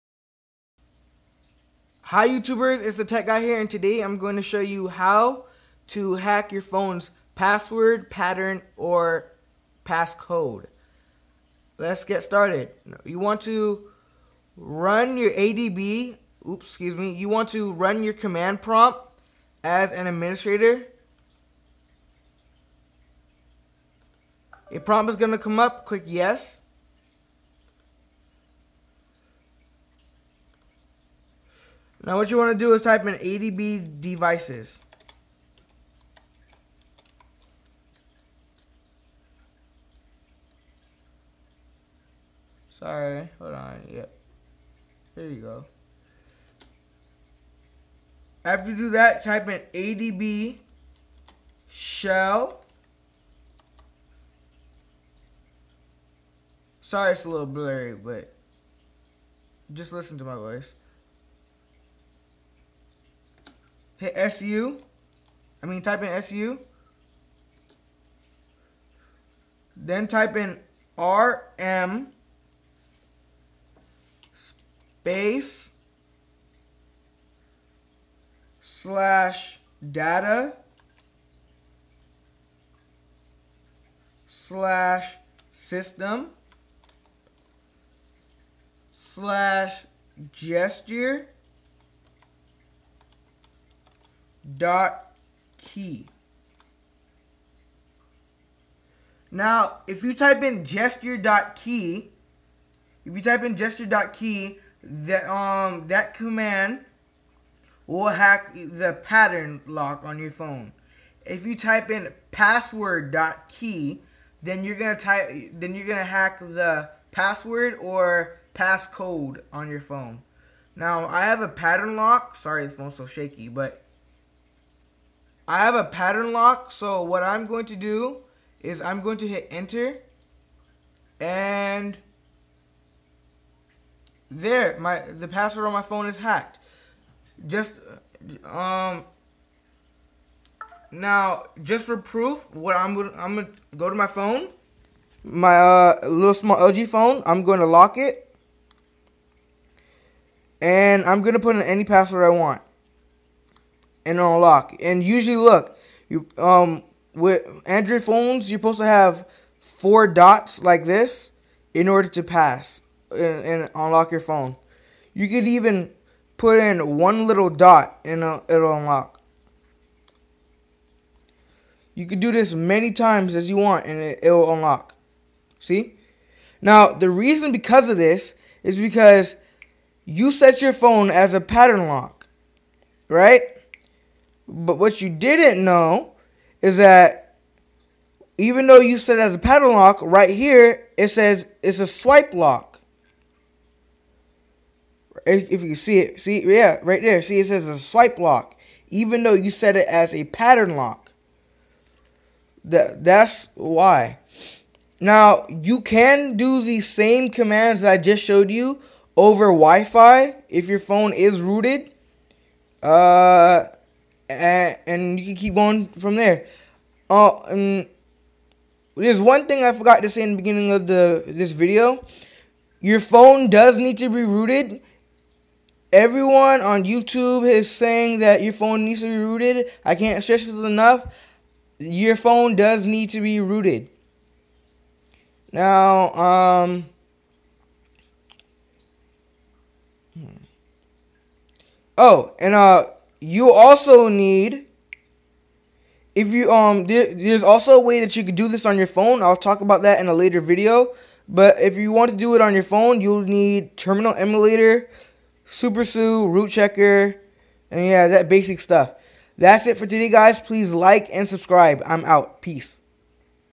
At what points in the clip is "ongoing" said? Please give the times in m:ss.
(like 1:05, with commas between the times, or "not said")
not said.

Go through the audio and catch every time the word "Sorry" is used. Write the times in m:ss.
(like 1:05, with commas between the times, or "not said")
0:42, 0:56, 2:02.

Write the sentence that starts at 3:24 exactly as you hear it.
Now you can do the same commands I just showed you over Wi-Fi if your phone is rooted.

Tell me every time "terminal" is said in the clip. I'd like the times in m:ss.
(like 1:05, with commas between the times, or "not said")
4:13.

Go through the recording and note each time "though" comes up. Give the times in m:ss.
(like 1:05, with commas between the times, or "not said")
3:08, 3:19.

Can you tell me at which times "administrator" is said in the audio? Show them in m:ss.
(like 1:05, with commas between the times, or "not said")
0:20.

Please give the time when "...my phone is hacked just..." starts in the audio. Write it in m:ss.
2:15.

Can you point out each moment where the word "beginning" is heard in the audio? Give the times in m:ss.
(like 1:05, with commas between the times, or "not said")
3:40.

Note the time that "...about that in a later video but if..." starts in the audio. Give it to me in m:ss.
4:09.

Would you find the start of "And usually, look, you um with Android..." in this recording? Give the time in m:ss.
2:34.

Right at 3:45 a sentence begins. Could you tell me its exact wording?
Everyone on YouTube is saying that your phone needs to be rooted.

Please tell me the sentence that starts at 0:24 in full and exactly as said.
A prompt is going to come up, click yes.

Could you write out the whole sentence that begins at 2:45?
You could even put in one little dot and uh, it'll unlock.